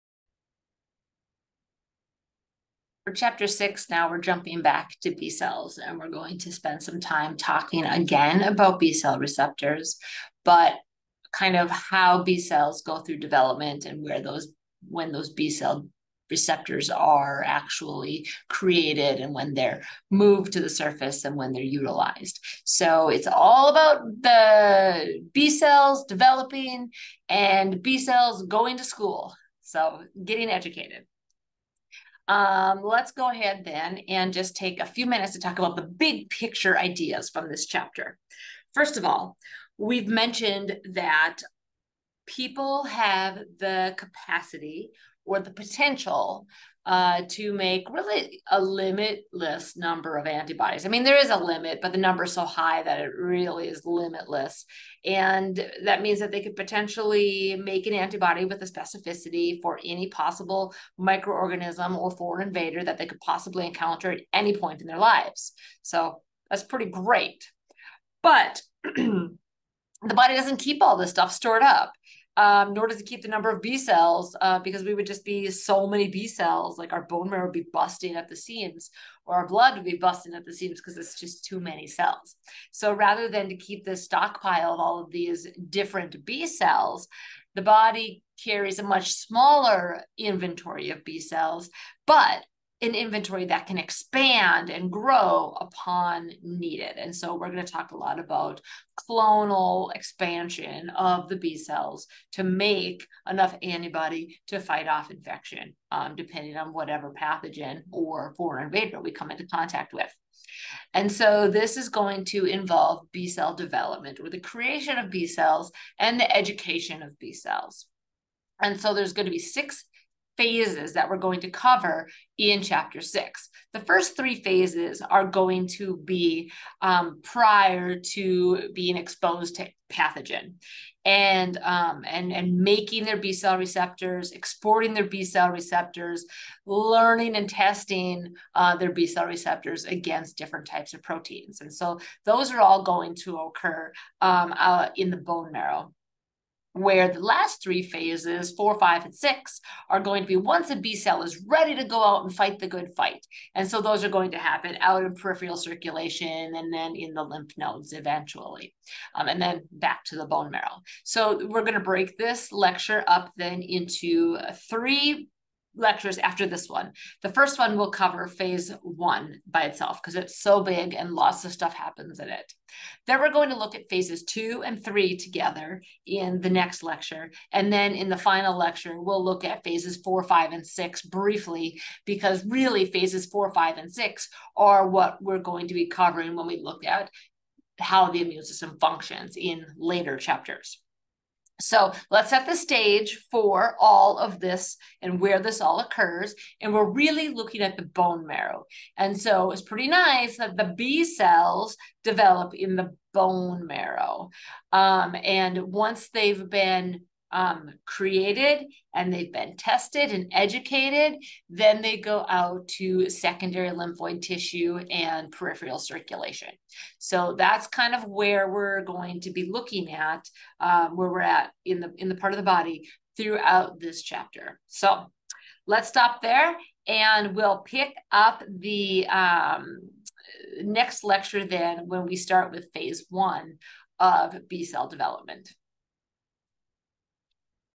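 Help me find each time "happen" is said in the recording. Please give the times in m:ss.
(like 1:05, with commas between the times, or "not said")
2:34, 2:51.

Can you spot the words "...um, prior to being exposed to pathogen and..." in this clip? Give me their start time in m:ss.
2:06.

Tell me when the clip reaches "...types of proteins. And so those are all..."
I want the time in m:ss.
2:20.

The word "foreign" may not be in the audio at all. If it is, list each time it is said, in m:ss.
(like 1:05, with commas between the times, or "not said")
1:02, 1:48.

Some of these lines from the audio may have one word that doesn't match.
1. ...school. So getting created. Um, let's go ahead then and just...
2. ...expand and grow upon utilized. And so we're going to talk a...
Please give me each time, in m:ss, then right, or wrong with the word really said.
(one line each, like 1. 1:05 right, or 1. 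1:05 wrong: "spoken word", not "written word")
1. 0:28 wrong: "educated", not "created"
2. 1:33 wrong: "needed", not "utilized".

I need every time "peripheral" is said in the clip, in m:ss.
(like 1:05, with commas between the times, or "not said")
2:35, 3:35.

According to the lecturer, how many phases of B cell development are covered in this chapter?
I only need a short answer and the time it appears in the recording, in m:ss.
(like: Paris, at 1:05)
6, at 1:59.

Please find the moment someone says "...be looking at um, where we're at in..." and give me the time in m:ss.
3:39.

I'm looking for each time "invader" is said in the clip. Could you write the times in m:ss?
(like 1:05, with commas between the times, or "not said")
1:02, 1:48.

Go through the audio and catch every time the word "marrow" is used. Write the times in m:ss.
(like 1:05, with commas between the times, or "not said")
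1:17, 2:25, 2:40, 3:18, 3:23.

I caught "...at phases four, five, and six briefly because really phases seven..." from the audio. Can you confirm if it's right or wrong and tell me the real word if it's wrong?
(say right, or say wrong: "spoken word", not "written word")
wrong: "four", not "seven".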